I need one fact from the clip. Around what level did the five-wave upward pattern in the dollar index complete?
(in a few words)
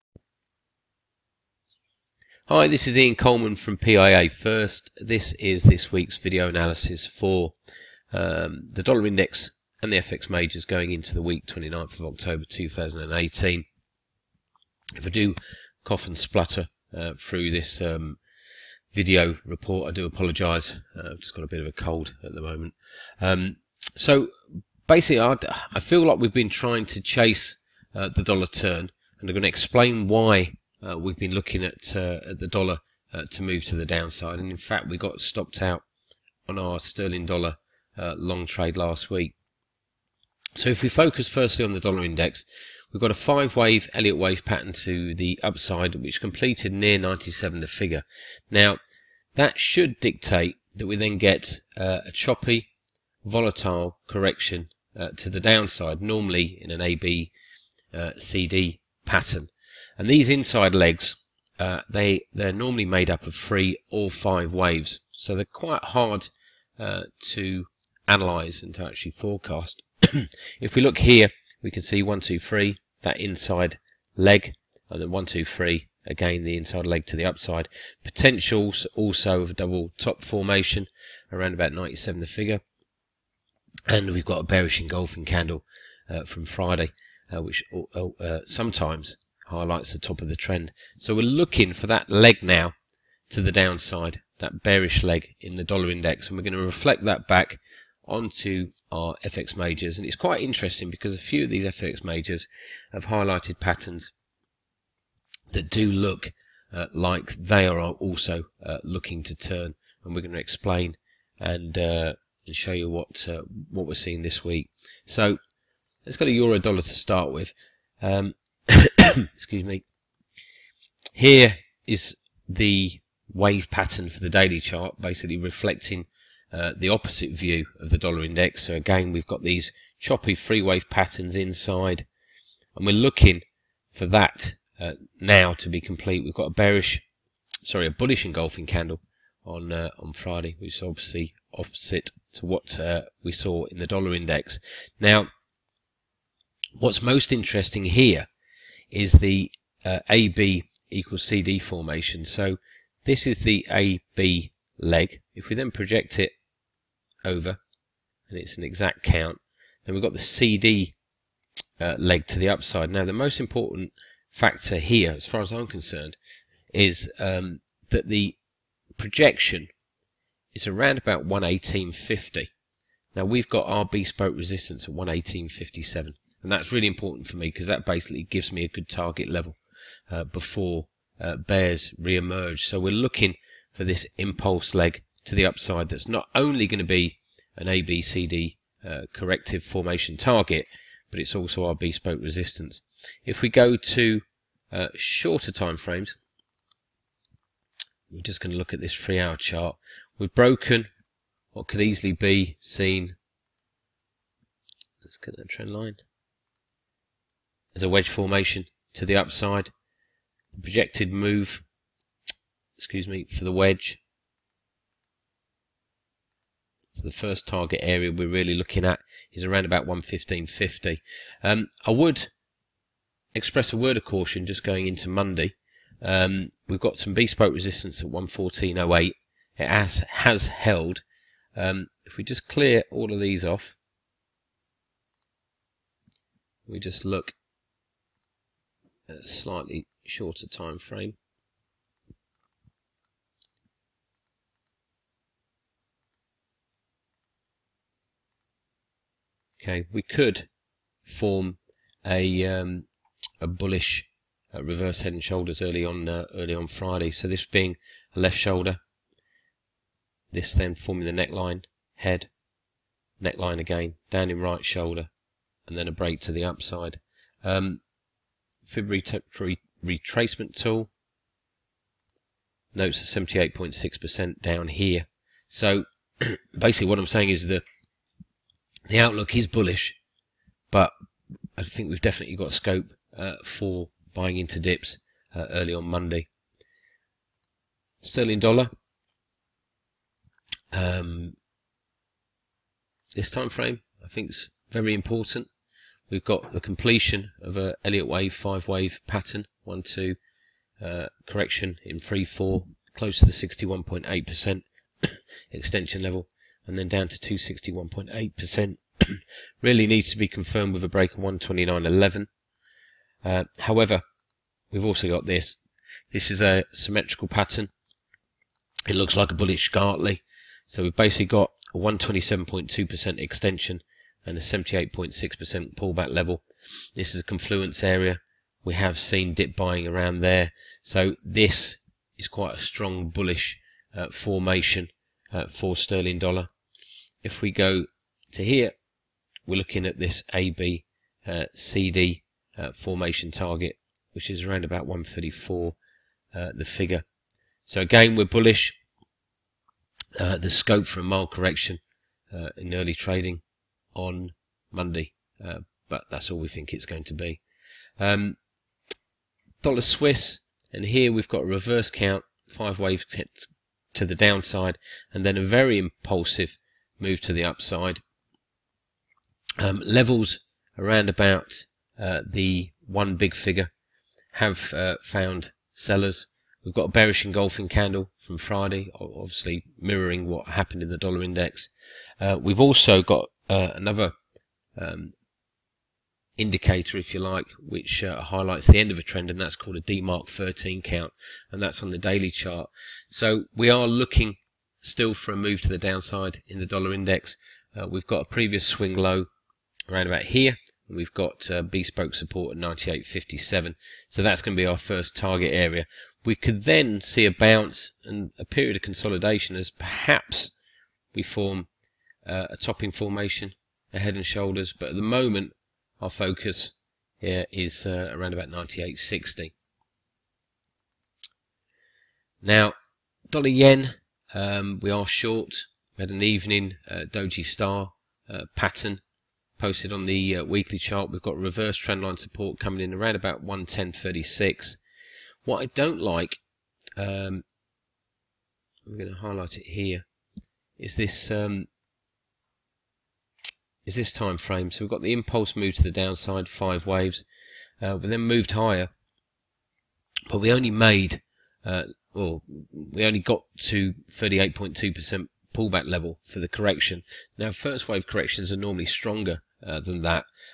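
97.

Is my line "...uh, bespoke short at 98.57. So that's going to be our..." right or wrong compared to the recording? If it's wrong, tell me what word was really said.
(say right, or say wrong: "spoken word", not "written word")
wrong: "support", not "short".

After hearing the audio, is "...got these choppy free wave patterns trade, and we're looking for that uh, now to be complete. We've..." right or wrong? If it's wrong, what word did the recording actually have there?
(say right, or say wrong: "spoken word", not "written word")
wrong: "inside", not "trade".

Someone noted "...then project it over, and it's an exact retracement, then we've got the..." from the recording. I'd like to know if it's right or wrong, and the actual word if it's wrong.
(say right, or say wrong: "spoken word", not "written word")
wrong: "count", not "retracement".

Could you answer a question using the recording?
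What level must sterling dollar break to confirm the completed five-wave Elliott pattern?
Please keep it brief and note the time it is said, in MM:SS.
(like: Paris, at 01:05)
129.11, at 05:11.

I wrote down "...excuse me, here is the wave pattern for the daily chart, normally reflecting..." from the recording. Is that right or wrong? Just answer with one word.
wrong.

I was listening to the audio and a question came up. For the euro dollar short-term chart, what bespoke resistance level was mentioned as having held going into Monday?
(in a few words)
114.08.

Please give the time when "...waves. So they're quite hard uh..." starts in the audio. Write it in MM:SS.
01:04.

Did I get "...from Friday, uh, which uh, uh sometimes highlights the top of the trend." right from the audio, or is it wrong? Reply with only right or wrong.
right.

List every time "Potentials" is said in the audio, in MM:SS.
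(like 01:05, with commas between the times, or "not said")
01:18.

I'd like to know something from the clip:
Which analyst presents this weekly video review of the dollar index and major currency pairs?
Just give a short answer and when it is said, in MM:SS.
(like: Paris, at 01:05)
Ian Coleman, at 00:02.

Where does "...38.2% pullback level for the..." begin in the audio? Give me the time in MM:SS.
07:34.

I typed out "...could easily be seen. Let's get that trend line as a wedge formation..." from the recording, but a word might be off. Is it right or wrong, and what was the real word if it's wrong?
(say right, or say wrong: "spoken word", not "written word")
right.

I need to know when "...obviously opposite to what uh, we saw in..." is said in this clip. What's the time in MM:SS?
02:20.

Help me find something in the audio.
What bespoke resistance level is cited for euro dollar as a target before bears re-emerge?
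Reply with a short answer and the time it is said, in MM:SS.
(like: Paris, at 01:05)
118.57, at 02:54.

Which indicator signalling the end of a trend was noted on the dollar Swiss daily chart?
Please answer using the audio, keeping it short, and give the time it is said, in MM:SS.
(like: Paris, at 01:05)
DeMark 13 count, at 06:29.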